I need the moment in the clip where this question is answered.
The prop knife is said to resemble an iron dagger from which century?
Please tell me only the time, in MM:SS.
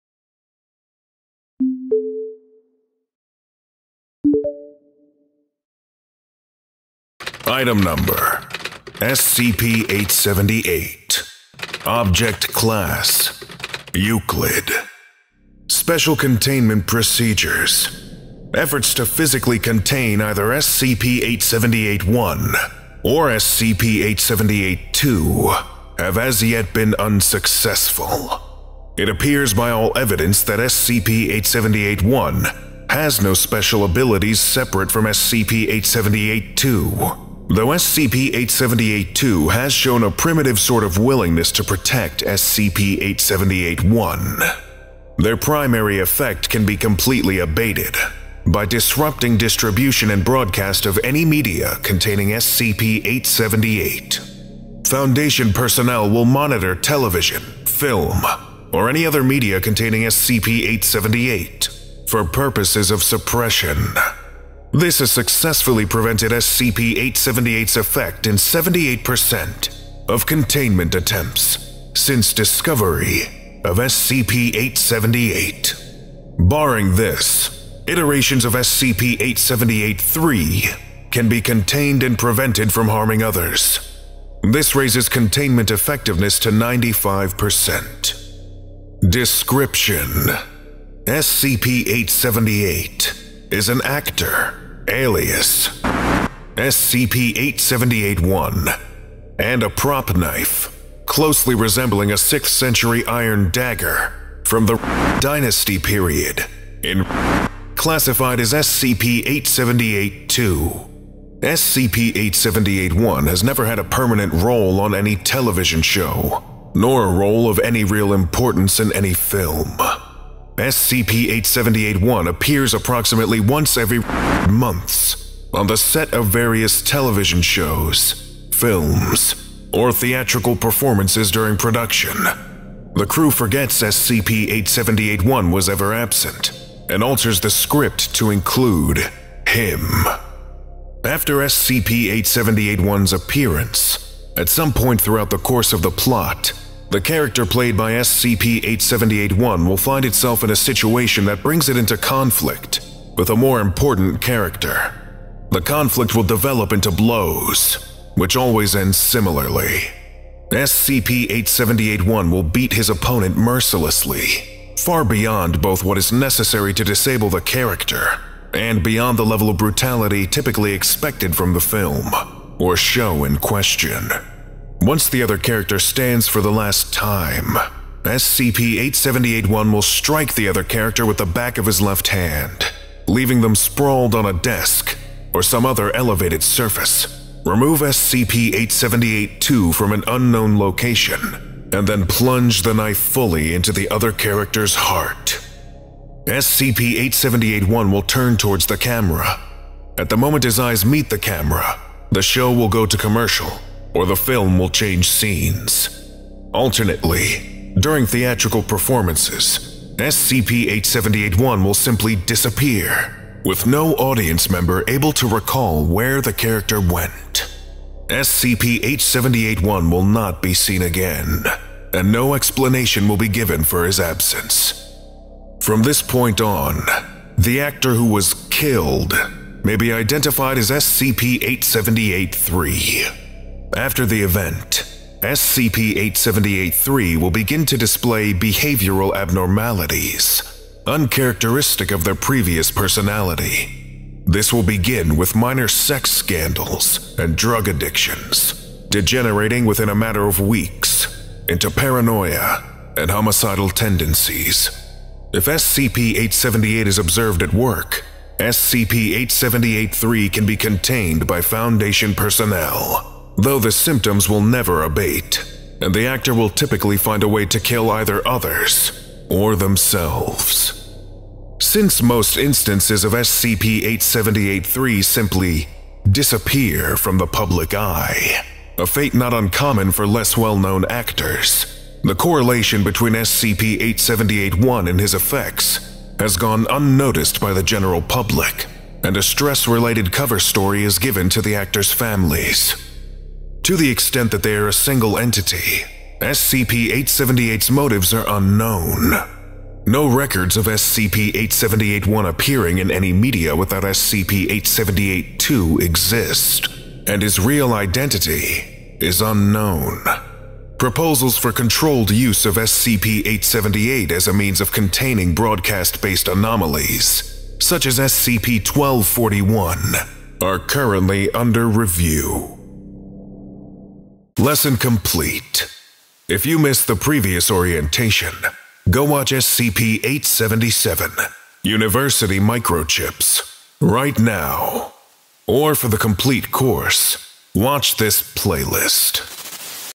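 01:42.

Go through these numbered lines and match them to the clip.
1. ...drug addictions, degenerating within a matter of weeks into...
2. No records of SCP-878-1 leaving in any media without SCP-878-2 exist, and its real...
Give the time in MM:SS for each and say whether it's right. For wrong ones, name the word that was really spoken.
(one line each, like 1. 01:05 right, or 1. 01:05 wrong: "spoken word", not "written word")
1. 04:07 right
2. 04:59 wrong: "appearing", not "leaving".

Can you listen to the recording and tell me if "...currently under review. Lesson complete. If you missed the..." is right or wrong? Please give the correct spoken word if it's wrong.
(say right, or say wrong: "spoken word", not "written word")
right.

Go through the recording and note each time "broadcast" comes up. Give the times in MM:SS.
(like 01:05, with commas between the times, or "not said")
00:50, 05:15.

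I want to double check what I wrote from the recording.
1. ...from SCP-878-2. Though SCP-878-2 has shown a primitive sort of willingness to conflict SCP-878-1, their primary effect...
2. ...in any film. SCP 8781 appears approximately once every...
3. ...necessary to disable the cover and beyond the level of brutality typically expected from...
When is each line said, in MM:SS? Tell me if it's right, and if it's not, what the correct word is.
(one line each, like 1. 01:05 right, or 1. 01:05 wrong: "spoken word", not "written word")
1. 00:34 wrong: "protect", not "conflict"
2. 01:58 right
3. 02:46 wrong: "character", not "cover".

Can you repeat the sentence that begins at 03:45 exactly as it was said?
From this point on, the actor who was killed may be identified as SCP 878 3.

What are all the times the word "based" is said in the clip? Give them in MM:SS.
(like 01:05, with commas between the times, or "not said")
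05:15.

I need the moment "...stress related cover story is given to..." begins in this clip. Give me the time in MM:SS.
04:49.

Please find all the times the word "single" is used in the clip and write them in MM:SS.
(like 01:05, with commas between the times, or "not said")
04:54.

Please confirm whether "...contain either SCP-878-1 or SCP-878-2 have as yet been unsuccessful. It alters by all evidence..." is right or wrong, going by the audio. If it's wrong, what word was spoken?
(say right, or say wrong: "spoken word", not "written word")
wrong: "appears", not "alters".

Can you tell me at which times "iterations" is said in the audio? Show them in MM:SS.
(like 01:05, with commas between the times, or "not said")
01:17.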